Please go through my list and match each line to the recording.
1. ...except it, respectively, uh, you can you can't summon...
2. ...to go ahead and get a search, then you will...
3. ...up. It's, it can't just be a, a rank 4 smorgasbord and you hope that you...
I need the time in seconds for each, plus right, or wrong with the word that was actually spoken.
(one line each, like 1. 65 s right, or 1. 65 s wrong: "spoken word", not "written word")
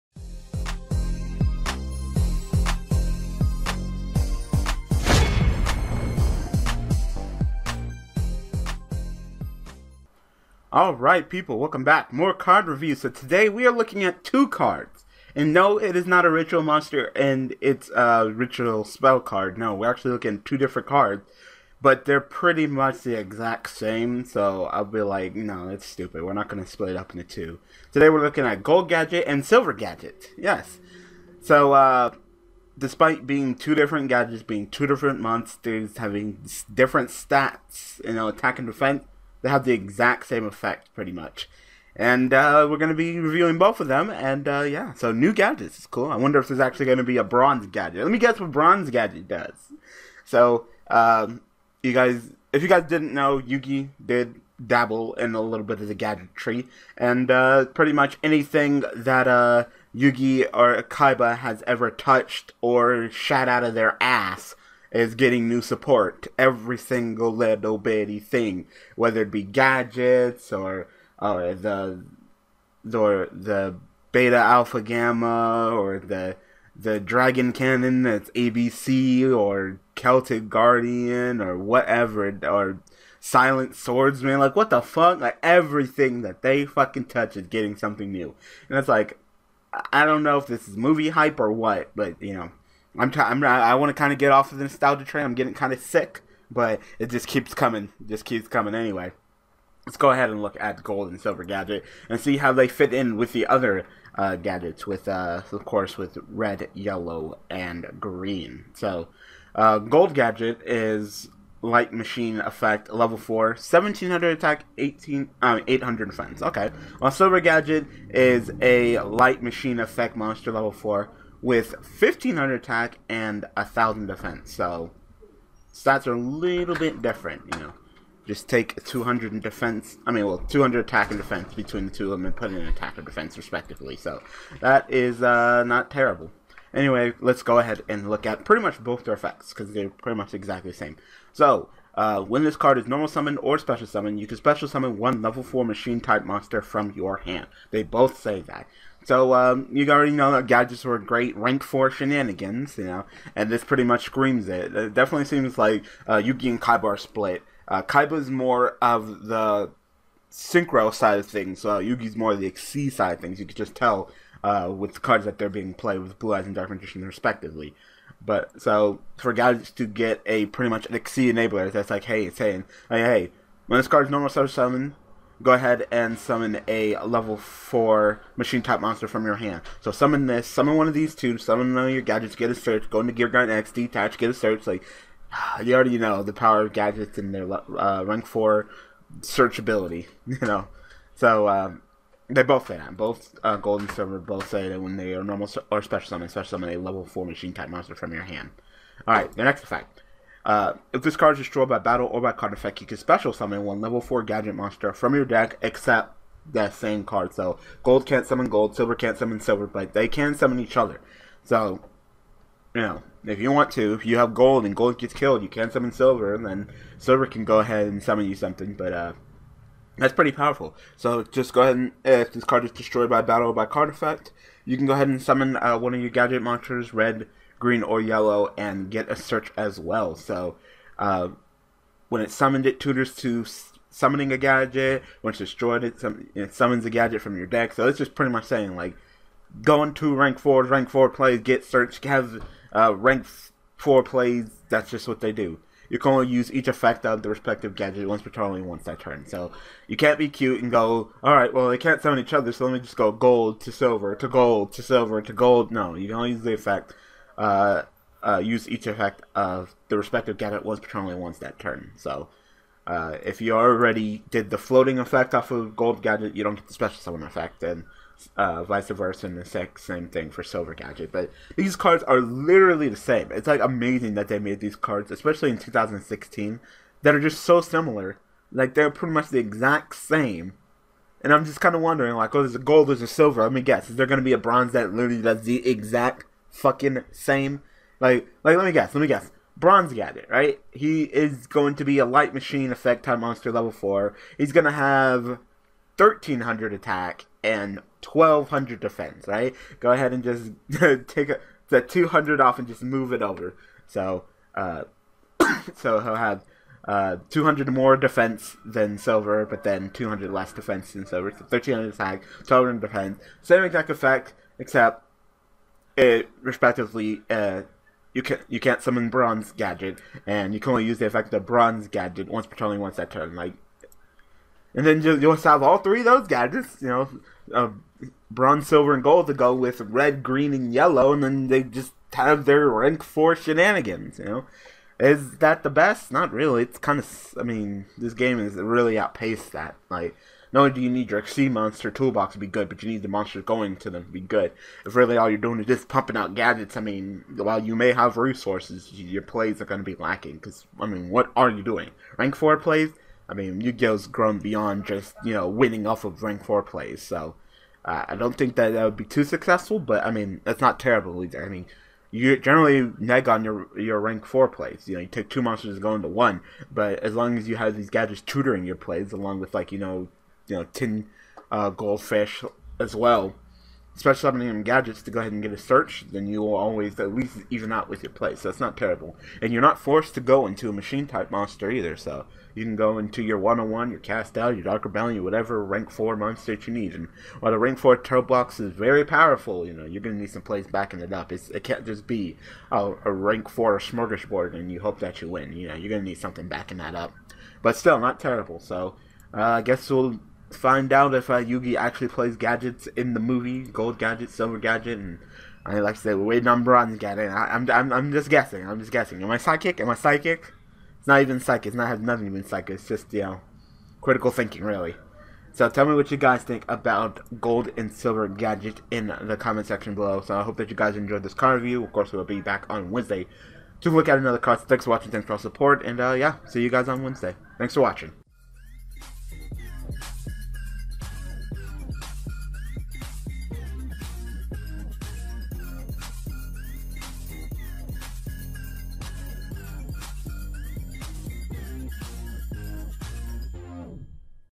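1. 314 s right
2. 375 s right
3. 391 s right.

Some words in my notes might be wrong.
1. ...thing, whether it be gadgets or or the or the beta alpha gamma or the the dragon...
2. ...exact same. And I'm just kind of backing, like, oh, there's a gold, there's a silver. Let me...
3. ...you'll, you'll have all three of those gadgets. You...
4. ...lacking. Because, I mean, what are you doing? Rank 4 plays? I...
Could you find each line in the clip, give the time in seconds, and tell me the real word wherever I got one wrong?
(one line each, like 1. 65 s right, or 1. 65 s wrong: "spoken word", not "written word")
1. 68 s right
2. 279 s wrong: "wondering", not "backing"
3. 325 s right
4. 349 s right.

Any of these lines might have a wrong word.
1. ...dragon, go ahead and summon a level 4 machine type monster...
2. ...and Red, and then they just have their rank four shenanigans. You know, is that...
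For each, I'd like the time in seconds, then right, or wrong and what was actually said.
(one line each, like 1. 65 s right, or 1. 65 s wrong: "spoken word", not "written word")
1. 174 s wrong: "summon", not "dragon"
2. 330 s wrong: "Yellow", not "Red".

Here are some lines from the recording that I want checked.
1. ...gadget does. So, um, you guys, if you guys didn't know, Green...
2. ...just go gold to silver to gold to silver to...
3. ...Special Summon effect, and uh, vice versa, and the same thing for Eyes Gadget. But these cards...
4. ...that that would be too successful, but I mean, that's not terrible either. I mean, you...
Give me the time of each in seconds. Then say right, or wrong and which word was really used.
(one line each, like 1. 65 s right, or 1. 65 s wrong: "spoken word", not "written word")
1. 48 s wrong: "Yugi", not "Green"
2. 252 s right
3. 266 s wrong: "Silver", not "Eyes"
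4. 358 s right.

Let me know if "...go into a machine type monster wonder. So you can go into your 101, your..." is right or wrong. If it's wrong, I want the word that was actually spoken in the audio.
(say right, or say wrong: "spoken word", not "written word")
wrong: "either", not "wonder".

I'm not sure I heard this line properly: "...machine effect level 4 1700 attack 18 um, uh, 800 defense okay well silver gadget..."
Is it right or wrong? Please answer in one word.
right.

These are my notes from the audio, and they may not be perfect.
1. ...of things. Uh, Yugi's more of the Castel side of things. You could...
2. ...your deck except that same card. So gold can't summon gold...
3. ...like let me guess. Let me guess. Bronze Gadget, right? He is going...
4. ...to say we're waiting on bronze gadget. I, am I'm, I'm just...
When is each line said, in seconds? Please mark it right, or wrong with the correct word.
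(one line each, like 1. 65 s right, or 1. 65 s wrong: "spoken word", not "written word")
1. 161 s wrong: "Xyz", not "Castel"
2. 205 s right
3. 288 s right
4. 405 s right.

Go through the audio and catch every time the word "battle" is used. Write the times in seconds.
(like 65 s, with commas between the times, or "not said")
201 s, 223 s.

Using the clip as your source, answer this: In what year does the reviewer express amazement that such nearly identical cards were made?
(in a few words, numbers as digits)
2016.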